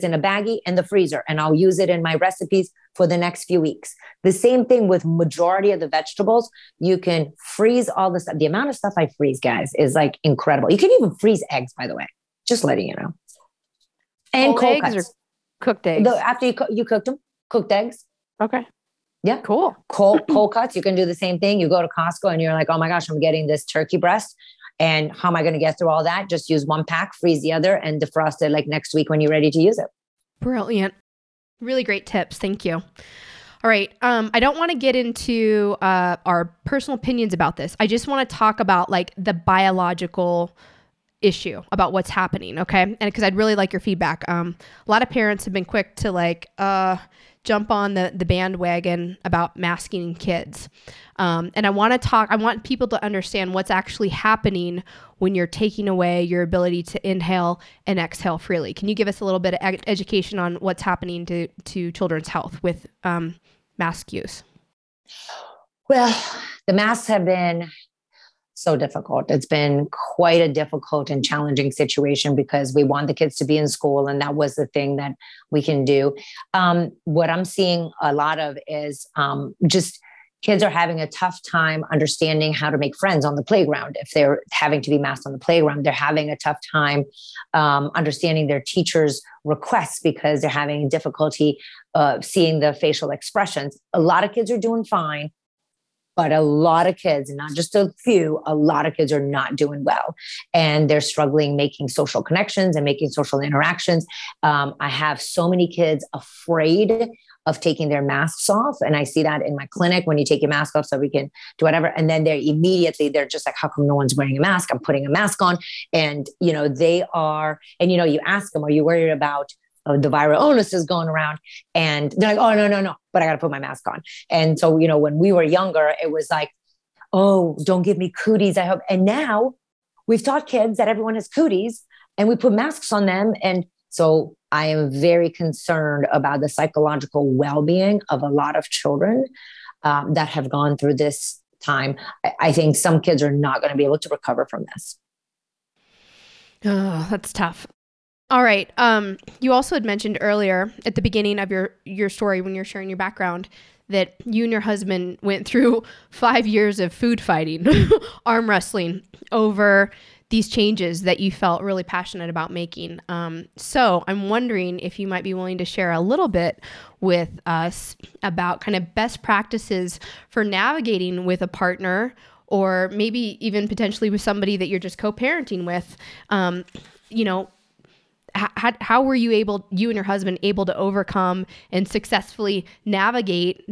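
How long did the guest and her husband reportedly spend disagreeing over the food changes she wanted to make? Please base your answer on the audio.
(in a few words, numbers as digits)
5 years.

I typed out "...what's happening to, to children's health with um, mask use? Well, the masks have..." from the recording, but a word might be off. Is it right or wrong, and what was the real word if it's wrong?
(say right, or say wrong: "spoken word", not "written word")
right.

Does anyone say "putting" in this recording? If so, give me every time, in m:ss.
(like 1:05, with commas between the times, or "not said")
1:54.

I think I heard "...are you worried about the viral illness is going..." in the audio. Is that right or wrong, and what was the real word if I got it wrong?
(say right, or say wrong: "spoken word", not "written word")
right.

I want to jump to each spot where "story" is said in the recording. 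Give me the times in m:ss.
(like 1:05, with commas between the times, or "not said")
2:32.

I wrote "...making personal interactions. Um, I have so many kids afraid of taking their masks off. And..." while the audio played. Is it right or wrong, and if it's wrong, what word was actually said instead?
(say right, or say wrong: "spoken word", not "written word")
wrong: "social", not "personal".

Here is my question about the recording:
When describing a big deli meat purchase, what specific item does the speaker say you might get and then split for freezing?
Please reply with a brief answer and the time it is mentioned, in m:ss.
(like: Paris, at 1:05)
turkey breast, at 0:23.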